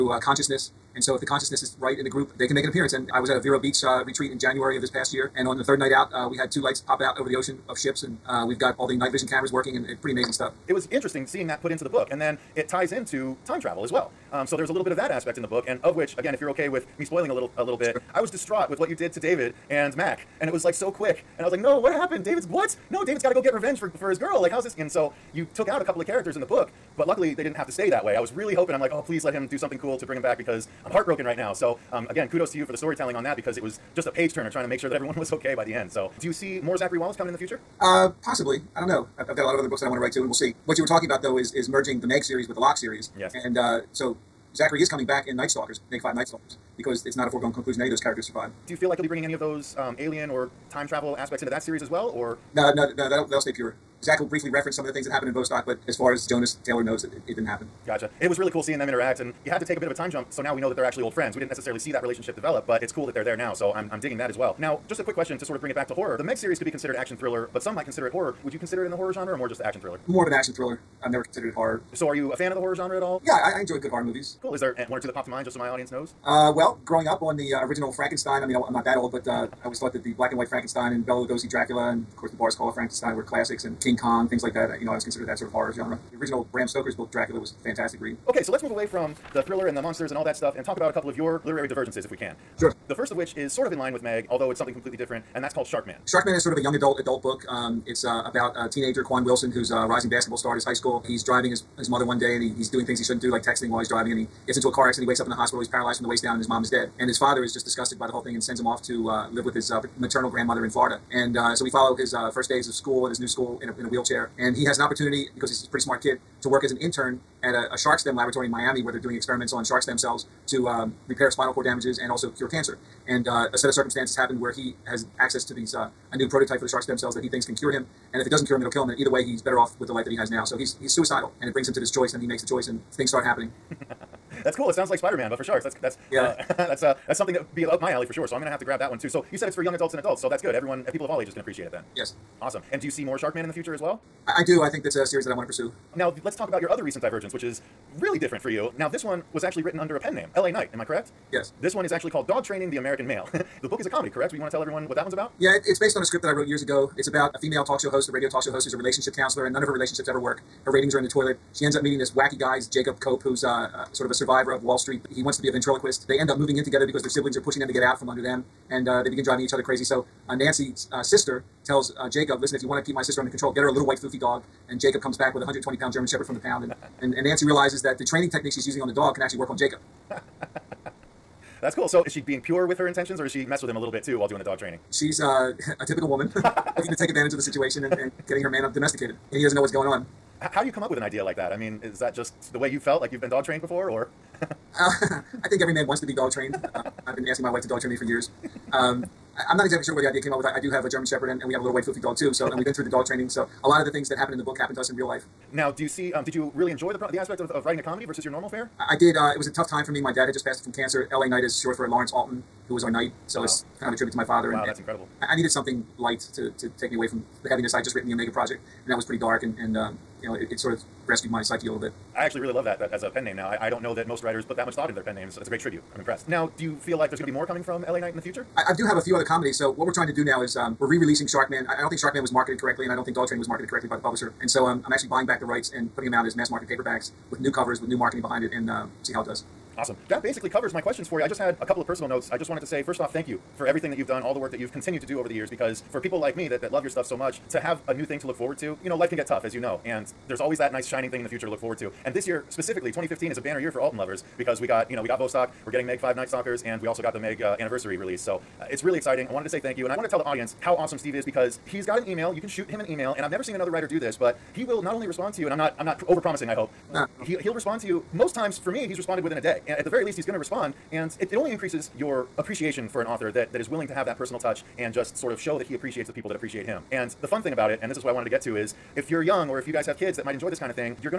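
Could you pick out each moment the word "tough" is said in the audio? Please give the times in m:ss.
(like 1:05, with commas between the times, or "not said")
3:29, 4:09.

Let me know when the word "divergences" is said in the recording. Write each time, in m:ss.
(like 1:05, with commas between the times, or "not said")
1:31, 2:27.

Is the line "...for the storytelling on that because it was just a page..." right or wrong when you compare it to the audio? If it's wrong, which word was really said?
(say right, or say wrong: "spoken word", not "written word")
right.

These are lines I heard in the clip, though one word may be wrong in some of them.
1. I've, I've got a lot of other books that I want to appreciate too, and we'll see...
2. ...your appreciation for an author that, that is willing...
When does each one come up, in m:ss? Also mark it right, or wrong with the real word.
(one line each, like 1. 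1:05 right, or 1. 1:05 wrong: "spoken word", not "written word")
1. 0:39 wrong: "write", not "appreciate"
2. 4:31 right.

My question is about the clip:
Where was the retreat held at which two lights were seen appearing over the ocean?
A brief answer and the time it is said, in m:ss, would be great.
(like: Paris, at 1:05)
Vero Beach, at 0:03.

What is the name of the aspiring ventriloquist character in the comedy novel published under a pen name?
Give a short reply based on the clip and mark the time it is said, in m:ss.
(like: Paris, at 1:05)
Jacob Cope, at 2:42.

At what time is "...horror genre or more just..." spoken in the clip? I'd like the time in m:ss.
1:08.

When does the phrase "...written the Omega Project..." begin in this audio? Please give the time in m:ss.
3:37.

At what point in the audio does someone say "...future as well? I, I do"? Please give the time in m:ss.
2:23.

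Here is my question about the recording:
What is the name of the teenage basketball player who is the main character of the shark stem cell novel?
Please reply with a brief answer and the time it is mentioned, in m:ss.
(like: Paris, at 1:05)
Quan Wilson, at 1:39.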